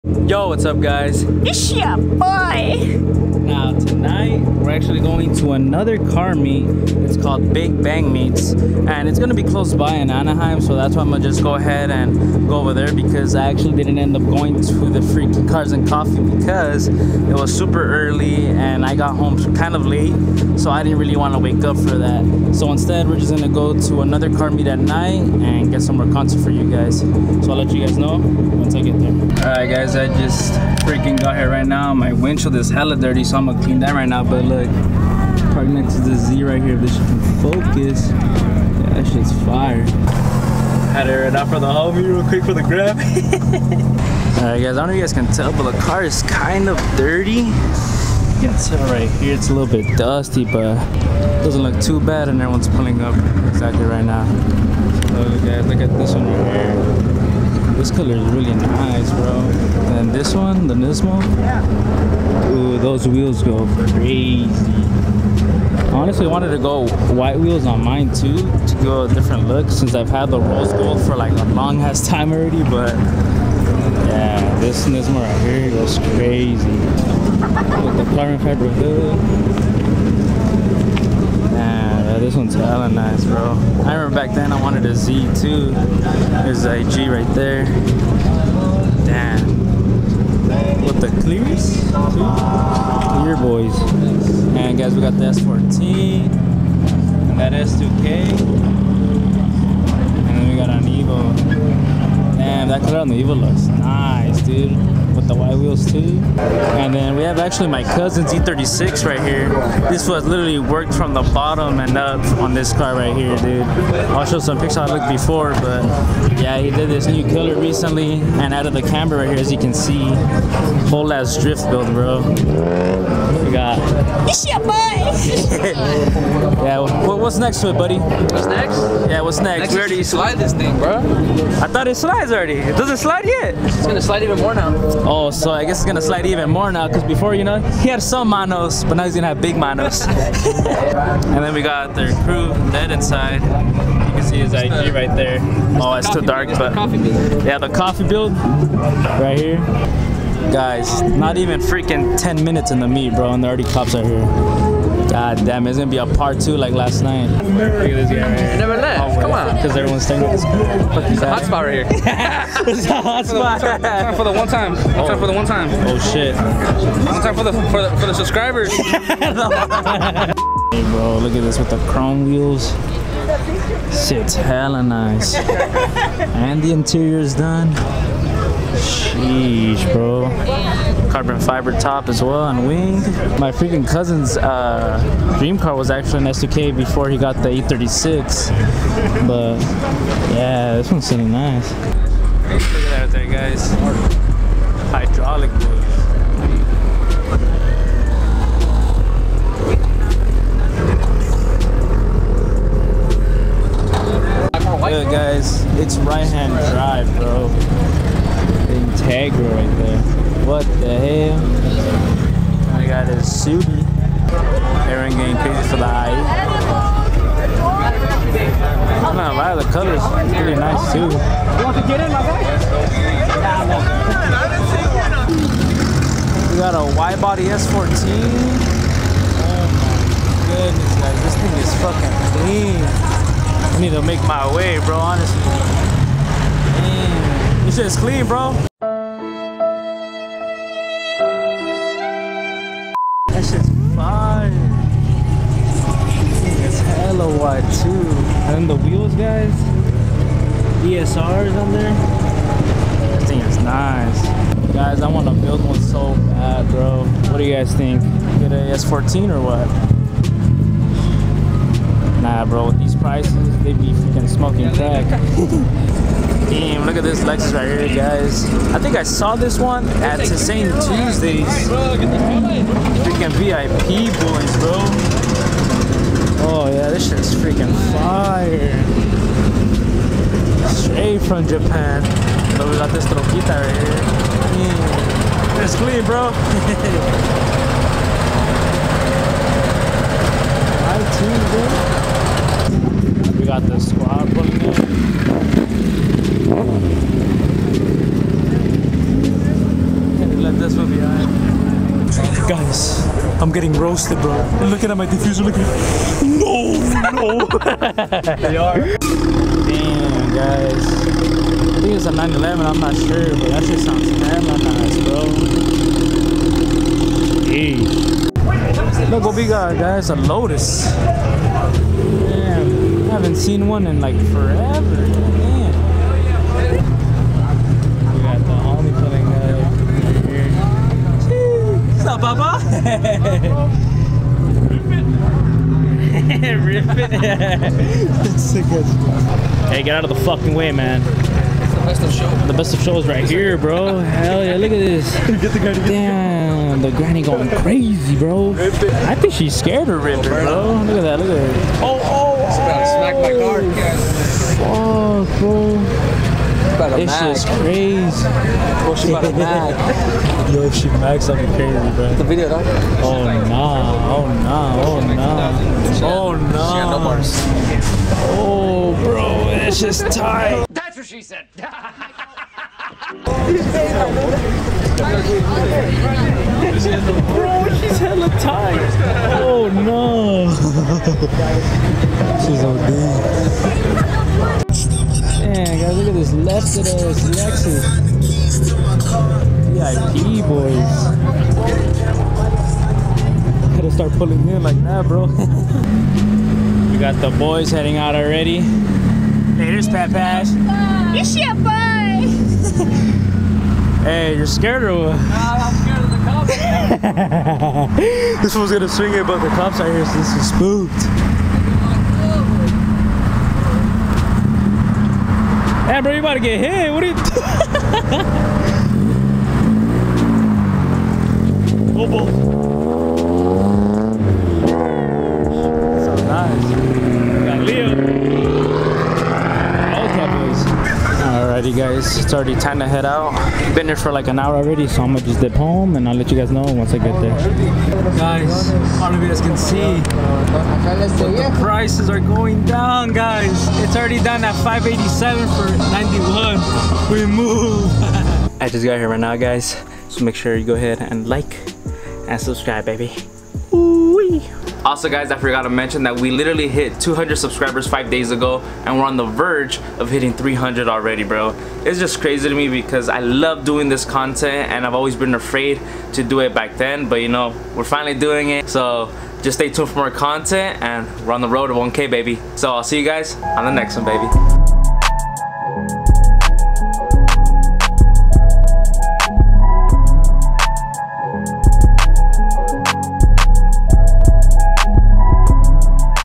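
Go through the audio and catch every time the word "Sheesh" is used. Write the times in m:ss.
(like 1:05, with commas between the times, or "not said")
2:58.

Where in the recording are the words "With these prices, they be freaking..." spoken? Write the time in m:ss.
4:22.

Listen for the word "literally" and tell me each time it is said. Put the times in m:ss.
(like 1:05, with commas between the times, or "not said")
1:50, 7:36.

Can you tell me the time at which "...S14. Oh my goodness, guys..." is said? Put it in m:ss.
3:47.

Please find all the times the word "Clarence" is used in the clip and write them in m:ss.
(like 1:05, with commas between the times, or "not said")
1:18.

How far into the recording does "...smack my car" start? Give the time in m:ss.
5:53.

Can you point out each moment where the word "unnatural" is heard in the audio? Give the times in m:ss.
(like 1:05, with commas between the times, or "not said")
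not said.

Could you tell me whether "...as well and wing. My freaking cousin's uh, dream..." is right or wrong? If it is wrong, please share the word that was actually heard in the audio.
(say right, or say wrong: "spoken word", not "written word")
right.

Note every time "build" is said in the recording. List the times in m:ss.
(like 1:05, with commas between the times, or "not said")
2:01, 2:28, 4:15.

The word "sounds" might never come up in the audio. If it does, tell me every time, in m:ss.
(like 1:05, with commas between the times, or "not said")
5:13.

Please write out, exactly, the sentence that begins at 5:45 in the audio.
Get the granny, Damn, the granny going crazy, bro.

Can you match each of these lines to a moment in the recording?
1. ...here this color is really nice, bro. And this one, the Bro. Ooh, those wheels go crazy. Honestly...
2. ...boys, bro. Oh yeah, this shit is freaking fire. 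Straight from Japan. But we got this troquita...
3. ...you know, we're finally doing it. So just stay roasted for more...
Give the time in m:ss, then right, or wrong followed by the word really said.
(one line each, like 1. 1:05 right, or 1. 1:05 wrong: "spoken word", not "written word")
1. 0:56 wrong: "Nismo", not "Bro"
2. 4:34 right
3. 7:47 wrong: "tuned", not "roasted".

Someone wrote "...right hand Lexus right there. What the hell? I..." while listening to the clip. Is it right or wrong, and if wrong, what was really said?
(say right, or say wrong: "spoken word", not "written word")
wrong: "Niagara", not "Lexus".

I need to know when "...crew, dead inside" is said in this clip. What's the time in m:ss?
2:22.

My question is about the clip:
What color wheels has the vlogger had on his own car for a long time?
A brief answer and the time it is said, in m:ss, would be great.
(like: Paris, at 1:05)
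Rose gold, at 1:10.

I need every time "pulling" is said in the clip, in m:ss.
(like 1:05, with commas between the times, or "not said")
0:52, 4:54, 6:34.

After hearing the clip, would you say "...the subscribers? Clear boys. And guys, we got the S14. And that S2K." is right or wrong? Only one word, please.
wrong.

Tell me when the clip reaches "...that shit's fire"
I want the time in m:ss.
0:38.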